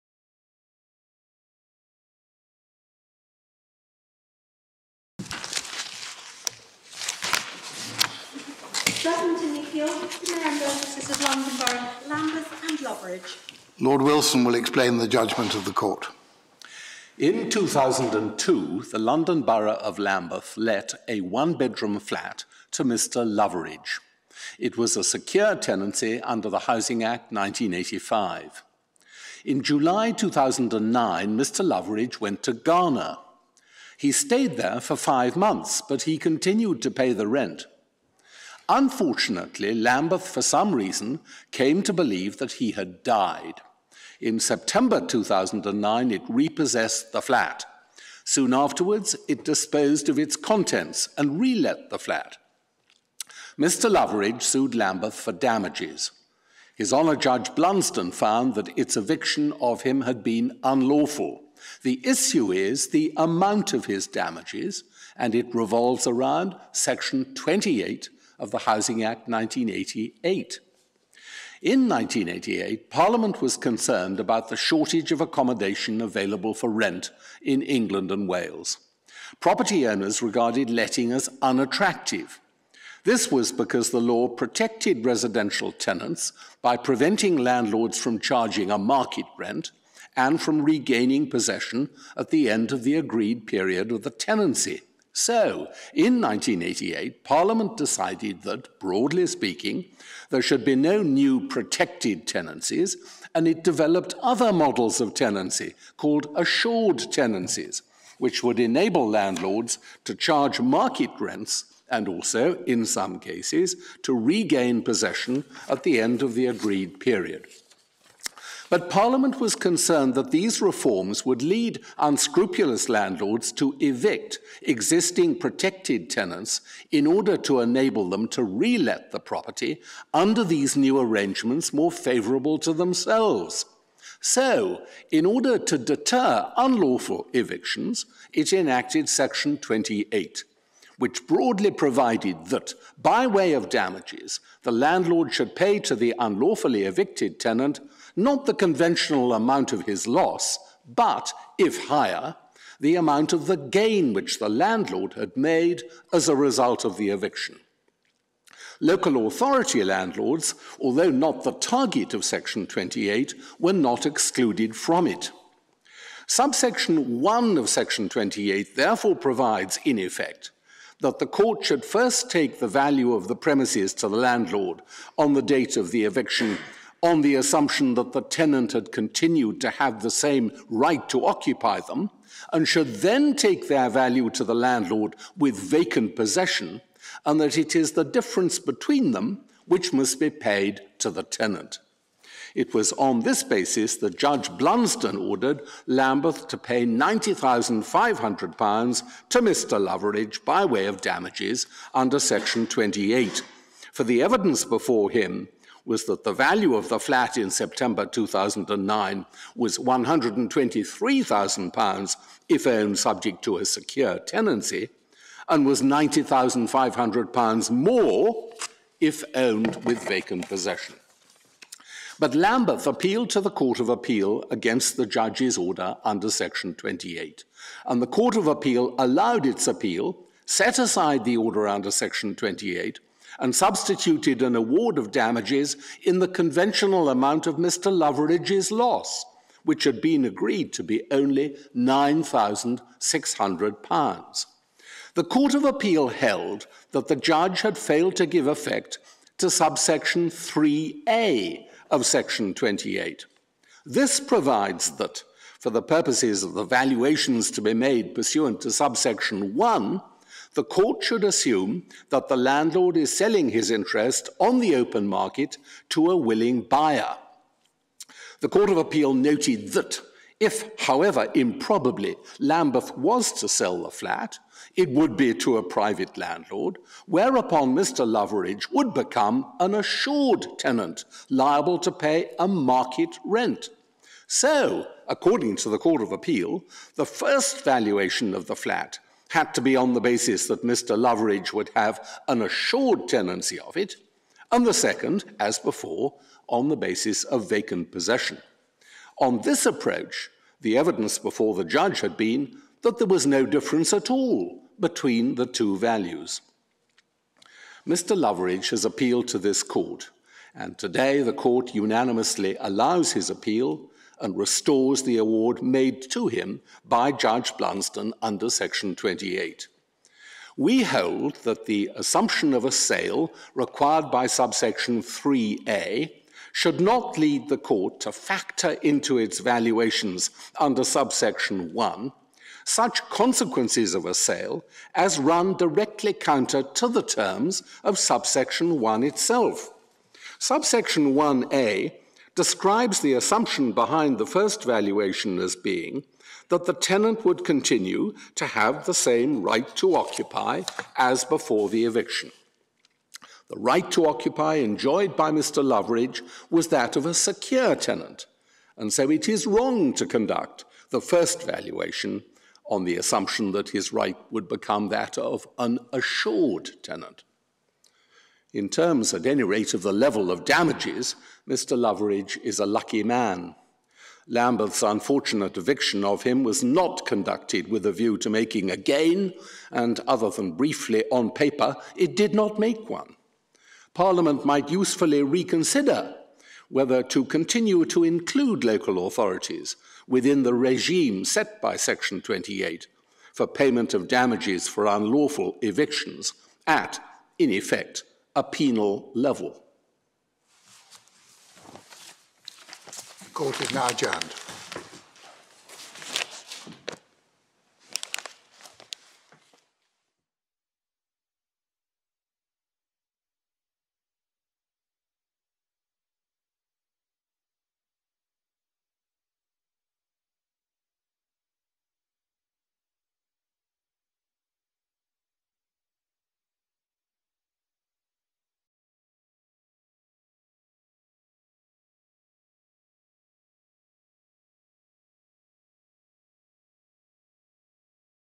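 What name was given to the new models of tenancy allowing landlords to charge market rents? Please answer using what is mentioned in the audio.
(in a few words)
assured tenancies.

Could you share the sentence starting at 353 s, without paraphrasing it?
The right to occupy enjoyed by Mr.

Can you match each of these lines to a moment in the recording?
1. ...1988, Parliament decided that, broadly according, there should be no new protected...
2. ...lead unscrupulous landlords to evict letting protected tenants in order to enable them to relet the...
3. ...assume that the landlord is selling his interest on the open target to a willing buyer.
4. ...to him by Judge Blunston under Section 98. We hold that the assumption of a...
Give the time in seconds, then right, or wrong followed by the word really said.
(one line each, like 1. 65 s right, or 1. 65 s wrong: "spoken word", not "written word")
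1. 96 s wrong: "speaking", not "according"
2. 121 s wrong: "existing", not "letting"
3. 261 s wrong: "market", not "target"
4. 316 s wrong: "28", not "98".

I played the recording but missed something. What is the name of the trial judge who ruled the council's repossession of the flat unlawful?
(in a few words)
His Honour Judge Blunston.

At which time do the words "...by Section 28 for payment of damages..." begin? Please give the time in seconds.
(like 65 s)
391 s.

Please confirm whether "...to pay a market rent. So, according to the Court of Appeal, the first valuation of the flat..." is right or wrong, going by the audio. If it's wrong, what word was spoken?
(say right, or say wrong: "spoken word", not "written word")
right.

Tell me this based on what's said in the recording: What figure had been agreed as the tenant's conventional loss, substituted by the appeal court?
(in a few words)
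£9,600.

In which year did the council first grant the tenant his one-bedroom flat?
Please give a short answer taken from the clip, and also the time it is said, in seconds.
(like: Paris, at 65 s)
2002, at 17 s.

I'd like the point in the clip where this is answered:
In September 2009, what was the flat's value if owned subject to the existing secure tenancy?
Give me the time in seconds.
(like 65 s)
209 s.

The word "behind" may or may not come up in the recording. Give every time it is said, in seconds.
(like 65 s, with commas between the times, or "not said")
343 s.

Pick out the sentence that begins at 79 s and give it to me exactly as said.
Property owners regarded letting as unattractive.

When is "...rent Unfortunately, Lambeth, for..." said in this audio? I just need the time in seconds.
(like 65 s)
37 s.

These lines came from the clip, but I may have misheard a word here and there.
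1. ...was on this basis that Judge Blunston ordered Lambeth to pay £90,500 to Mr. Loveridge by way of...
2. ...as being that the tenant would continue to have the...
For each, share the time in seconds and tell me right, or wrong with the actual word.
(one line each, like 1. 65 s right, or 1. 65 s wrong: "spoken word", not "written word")
1. 192 s right
2. 345 s right.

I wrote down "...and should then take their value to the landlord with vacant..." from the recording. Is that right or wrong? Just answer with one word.
right.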